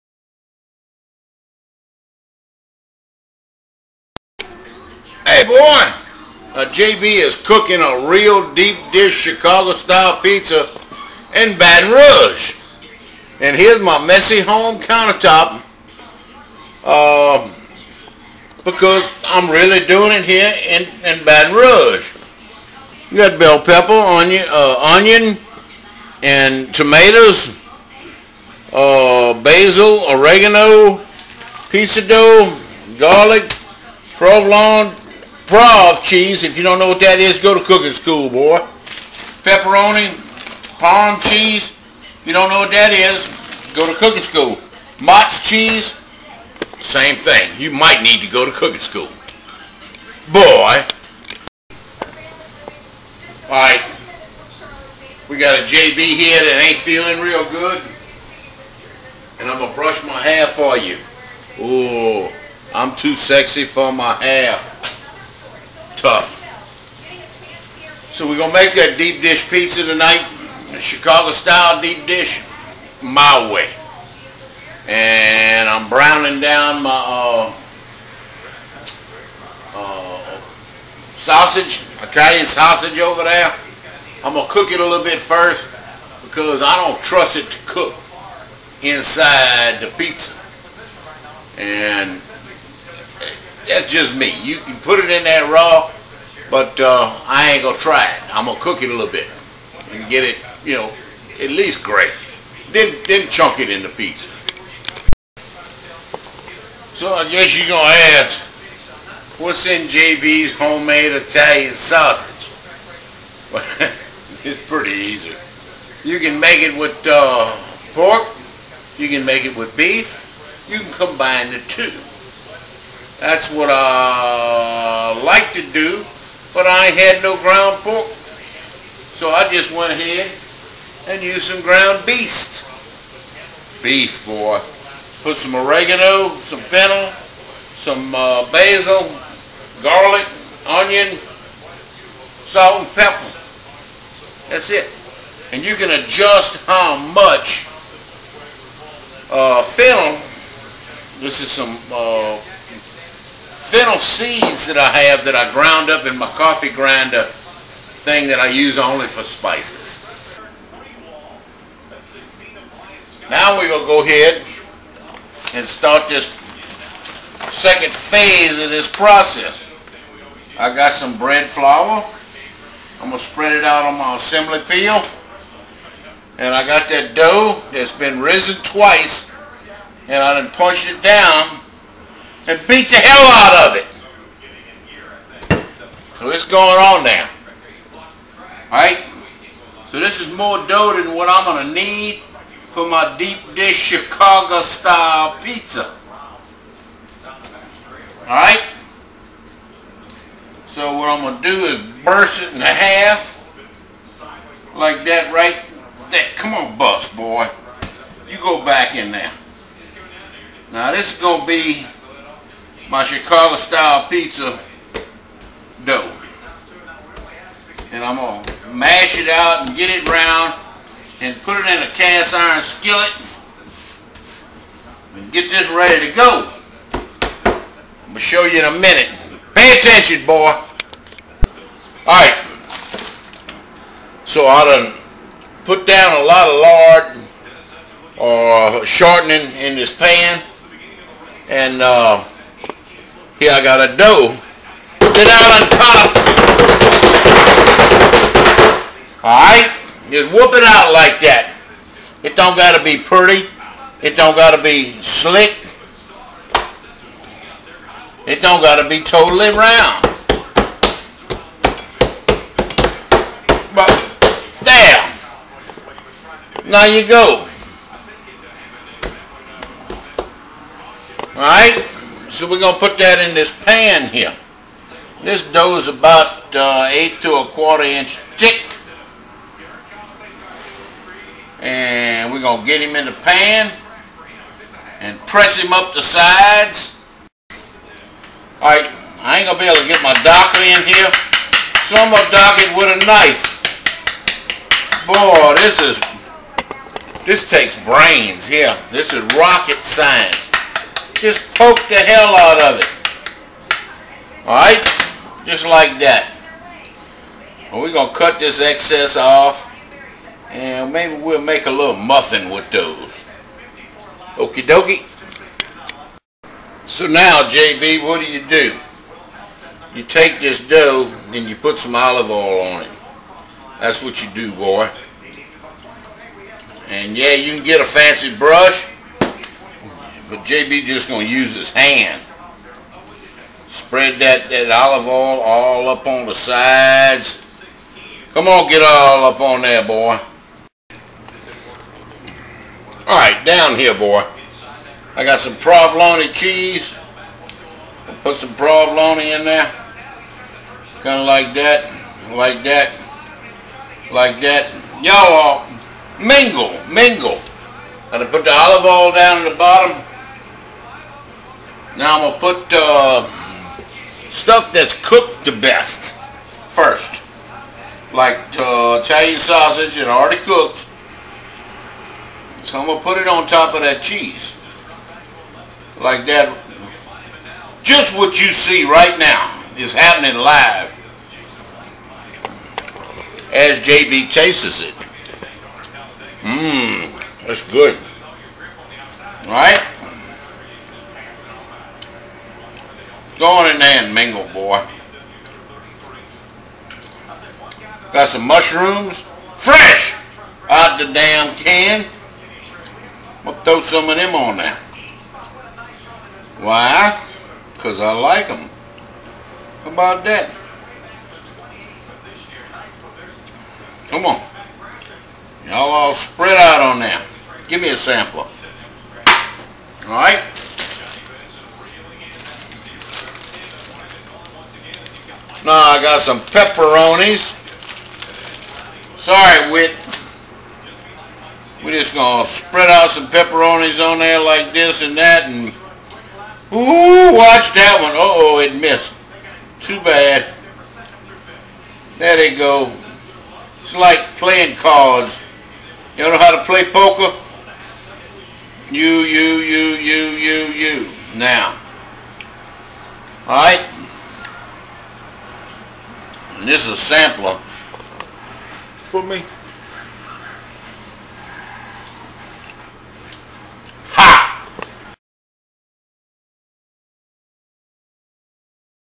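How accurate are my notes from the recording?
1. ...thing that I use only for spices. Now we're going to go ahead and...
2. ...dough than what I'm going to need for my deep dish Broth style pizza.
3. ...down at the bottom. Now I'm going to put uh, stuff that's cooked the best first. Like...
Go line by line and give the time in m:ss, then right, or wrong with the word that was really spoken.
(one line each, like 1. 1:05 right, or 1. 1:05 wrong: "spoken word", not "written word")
1. 2:38 right
2. 3:10 wrong: "Chicago", not "Broth"
3. 5:59 right.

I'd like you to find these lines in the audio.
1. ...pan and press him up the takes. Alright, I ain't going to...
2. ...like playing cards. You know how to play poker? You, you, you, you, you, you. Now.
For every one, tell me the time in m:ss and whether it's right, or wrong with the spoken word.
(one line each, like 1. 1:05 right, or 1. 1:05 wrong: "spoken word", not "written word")
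1. 4:43 wrong: "sides", not "takes"
2. 7:23 right.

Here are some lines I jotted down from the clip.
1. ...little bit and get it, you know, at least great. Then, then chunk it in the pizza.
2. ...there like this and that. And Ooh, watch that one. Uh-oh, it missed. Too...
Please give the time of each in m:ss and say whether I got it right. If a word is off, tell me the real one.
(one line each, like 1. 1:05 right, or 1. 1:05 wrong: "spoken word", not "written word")
1. 1:38 right
2. 7:14 right.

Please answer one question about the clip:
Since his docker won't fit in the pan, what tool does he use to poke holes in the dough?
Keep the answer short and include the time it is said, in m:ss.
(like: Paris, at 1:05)
a knife, at 4:53.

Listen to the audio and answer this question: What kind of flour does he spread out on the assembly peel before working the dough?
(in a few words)
bread flour.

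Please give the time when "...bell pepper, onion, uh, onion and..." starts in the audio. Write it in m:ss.
0:23.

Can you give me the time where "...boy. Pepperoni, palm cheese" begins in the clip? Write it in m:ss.
0:38.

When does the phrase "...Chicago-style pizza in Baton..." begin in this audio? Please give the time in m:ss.
0:09.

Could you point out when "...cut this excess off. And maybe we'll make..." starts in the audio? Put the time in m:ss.
5:08.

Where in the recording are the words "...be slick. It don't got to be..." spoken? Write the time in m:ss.
4:14.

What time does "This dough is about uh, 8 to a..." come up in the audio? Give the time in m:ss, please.
4:35.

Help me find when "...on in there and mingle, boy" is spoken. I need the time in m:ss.
6:33.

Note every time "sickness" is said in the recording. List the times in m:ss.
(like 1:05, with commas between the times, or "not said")
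not said.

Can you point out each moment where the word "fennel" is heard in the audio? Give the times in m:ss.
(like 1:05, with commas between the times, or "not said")
2:16, 2:29, 2:33.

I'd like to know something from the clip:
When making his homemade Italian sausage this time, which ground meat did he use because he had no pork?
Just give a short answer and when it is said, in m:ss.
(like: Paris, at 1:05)
ground beef, at 2:11.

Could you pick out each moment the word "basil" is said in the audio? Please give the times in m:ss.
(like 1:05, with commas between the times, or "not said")
0:29, 2:18.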